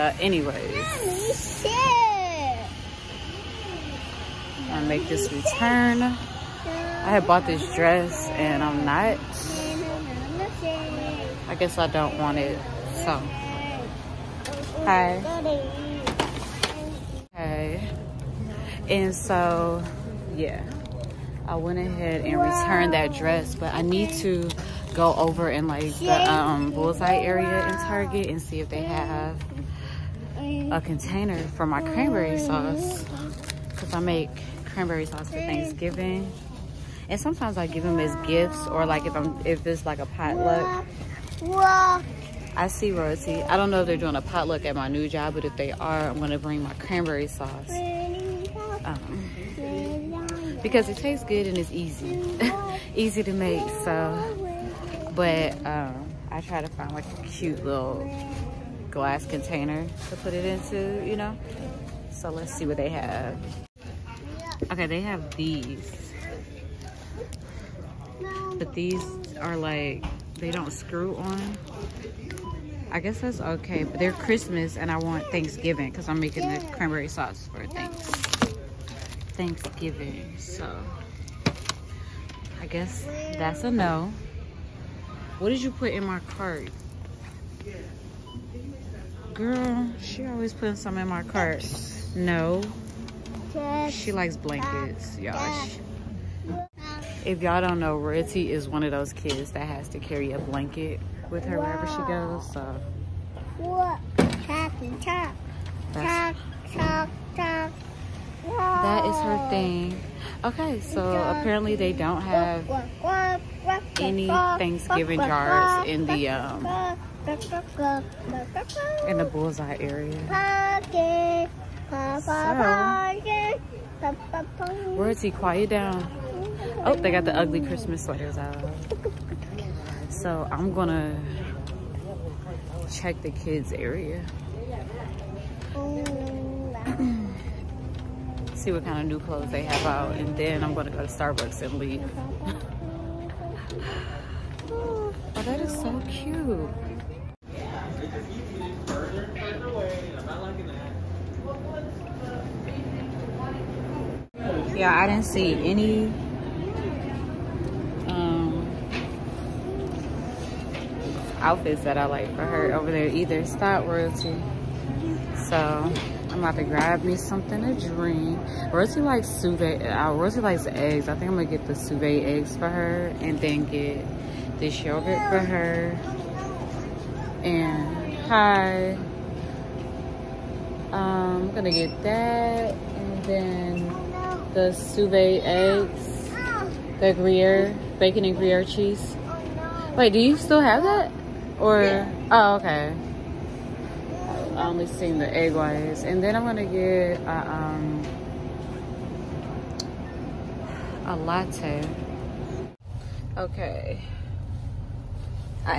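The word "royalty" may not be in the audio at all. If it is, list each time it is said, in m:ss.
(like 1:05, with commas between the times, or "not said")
1:37, 2:43.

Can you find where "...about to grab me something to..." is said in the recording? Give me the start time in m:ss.
2:46.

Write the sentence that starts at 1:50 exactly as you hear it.
Okay, so apparently they don't have any Thanksgiving jars in the um in the bullseye area.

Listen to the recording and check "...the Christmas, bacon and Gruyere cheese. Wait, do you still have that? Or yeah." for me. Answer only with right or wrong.
wrong.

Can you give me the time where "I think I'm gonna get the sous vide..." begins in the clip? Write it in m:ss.
2:51.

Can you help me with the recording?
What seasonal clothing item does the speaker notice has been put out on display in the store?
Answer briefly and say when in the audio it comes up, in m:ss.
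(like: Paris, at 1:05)
Ugly Christmas sweaters, at 2:07.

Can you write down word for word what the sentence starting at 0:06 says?
I had bought this dress and I'm not I guess I don't want it, so.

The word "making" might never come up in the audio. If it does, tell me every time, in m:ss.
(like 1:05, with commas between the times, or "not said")
1:16.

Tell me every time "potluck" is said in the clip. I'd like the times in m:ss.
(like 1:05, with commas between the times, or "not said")
0:40, 0:44.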